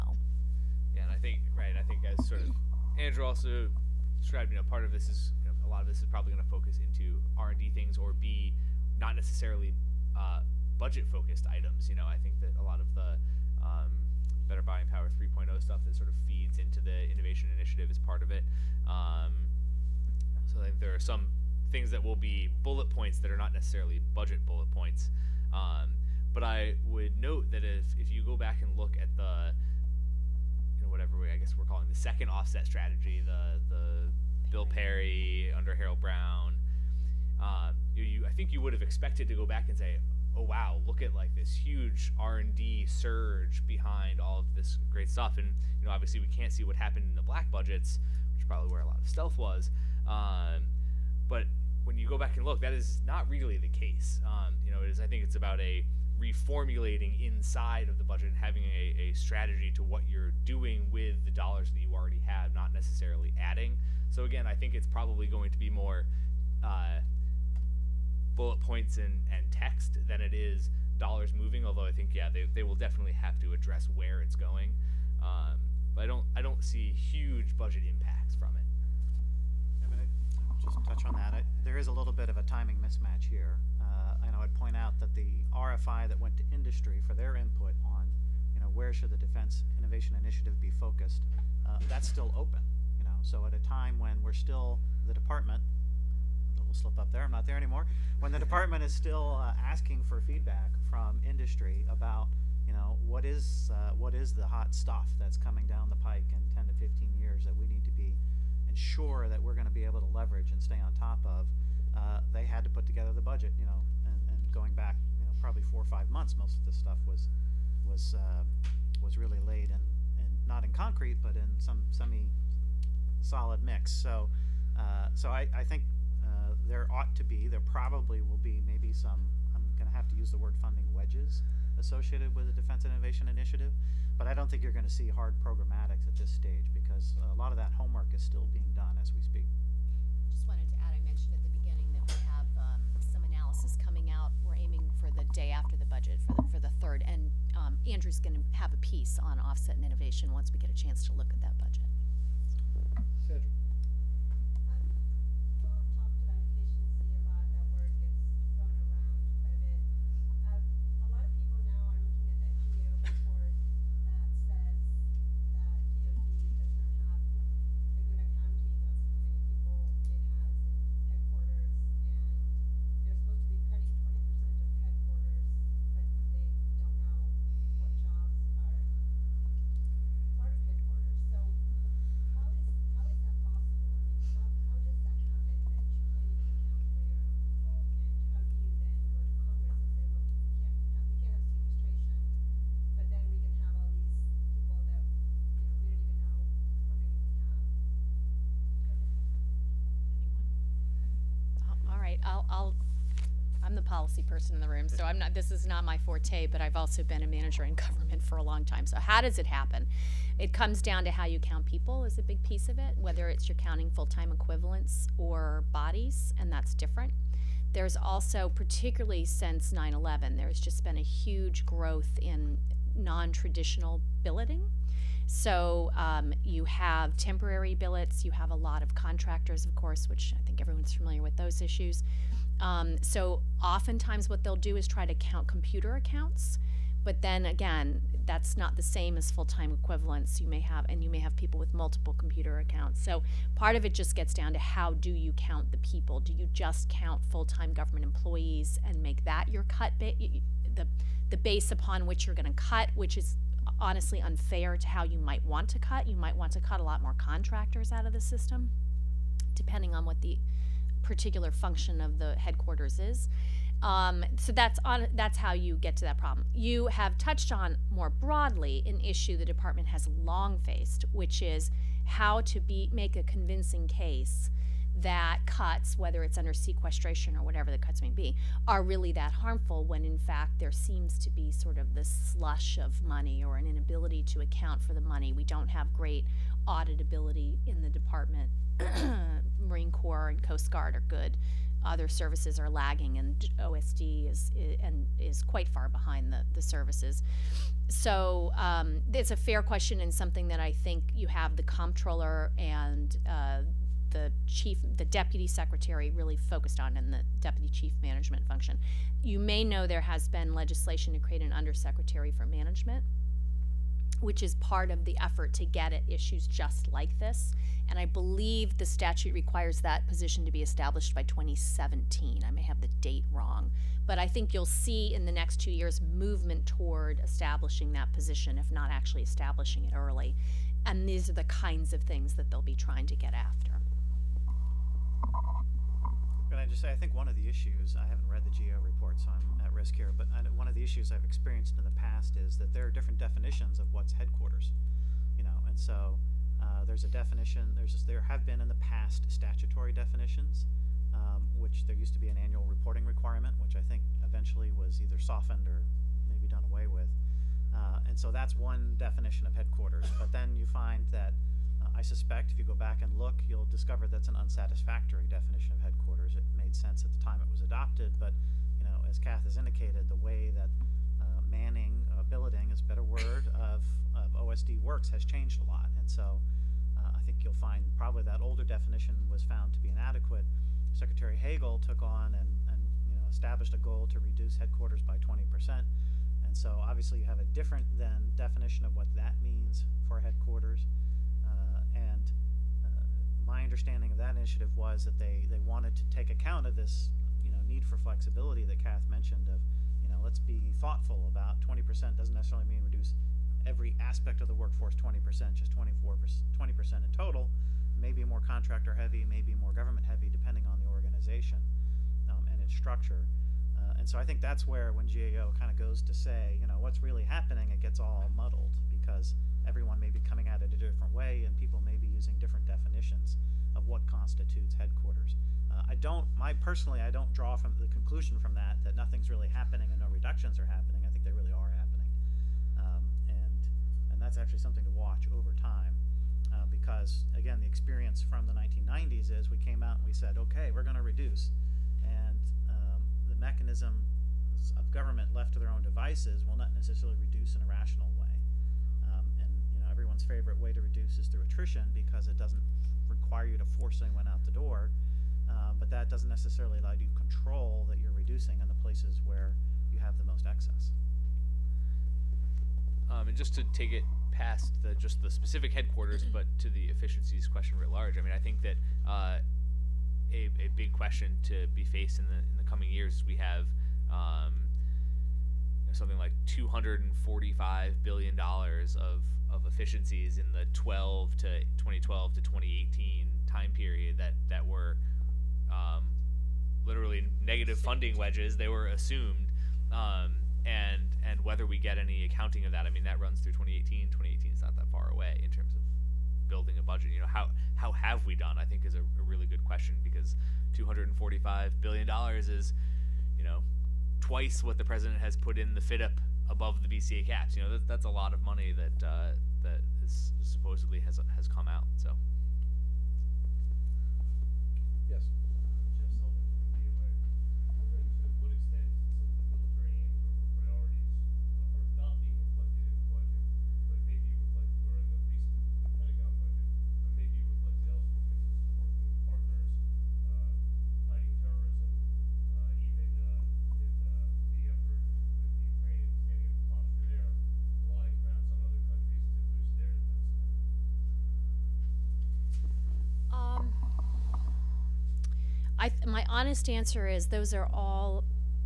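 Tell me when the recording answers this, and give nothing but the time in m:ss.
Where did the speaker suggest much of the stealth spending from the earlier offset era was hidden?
0:47.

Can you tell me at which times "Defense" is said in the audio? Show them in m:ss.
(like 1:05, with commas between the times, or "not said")
1:29, 2:12.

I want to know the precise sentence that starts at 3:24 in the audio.
person in the room, so I'm not.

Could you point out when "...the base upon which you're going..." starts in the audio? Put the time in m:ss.
4:11.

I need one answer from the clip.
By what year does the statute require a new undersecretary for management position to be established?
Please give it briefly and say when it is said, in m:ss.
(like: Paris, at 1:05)
2017, at 5:21.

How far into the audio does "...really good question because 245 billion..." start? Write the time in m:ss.
8:19.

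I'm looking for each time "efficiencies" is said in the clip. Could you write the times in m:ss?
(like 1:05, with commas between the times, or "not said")
7:46, 7:59.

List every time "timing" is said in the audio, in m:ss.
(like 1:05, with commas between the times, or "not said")
1:22.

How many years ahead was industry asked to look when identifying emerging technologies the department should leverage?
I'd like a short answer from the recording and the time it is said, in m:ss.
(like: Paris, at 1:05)
10 to 15 years, at 1:46.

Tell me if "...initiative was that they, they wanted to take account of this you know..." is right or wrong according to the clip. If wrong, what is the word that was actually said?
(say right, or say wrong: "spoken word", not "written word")
right.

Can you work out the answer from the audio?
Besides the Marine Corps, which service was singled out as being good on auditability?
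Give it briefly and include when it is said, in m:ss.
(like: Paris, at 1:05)
Coast Guard, at 4:50.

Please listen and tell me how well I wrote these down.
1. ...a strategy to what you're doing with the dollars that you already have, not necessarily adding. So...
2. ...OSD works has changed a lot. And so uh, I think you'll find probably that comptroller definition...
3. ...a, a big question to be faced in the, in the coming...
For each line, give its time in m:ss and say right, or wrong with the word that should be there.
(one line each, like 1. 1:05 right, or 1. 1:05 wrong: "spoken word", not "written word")
1. 0:58 right
2. 6:14 wrong: "older", not "comptroller"
3. 7:50 right.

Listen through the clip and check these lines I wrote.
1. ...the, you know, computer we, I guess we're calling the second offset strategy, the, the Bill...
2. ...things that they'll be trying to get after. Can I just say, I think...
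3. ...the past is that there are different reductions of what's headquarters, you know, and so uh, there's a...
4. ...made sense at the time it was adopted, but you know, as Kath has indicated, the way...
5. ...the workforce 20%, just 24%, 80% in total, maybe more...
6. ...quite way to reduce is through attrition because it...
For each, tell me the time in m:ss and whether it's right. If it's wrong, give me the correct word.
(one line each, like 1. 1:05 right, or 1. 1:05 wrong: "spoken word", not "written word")
1. 0:29 wrong: "whatever", not "computer"
2. 5:32 right
3. 5:41 wrong: "definitions", not "reductions"
4. 6:06 right
5. 6:44 wrong: "20", not "80"
6. 7:30 wrong: "favorite", not "quite".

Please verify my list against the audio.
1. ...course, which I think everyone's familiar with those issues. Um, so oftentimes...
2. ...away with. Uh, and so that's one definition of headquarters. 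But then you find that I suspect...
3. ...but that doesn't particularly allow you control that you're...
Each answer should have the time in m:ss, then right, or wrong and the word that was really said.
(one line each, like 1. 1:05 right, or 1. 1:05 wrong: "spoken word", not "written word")
1. 3:49 right
2. 5:56 right
3. 7:35 wrong: "necessarily", not "particularly".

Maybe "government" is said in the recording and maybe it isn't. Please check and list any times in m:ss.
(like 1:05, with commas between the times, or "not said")
3:27, 4:07, 6:49, 7:24.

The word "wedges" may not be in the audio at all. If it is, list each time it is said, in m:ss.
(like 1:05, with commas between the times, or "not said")
2:10, 8:08.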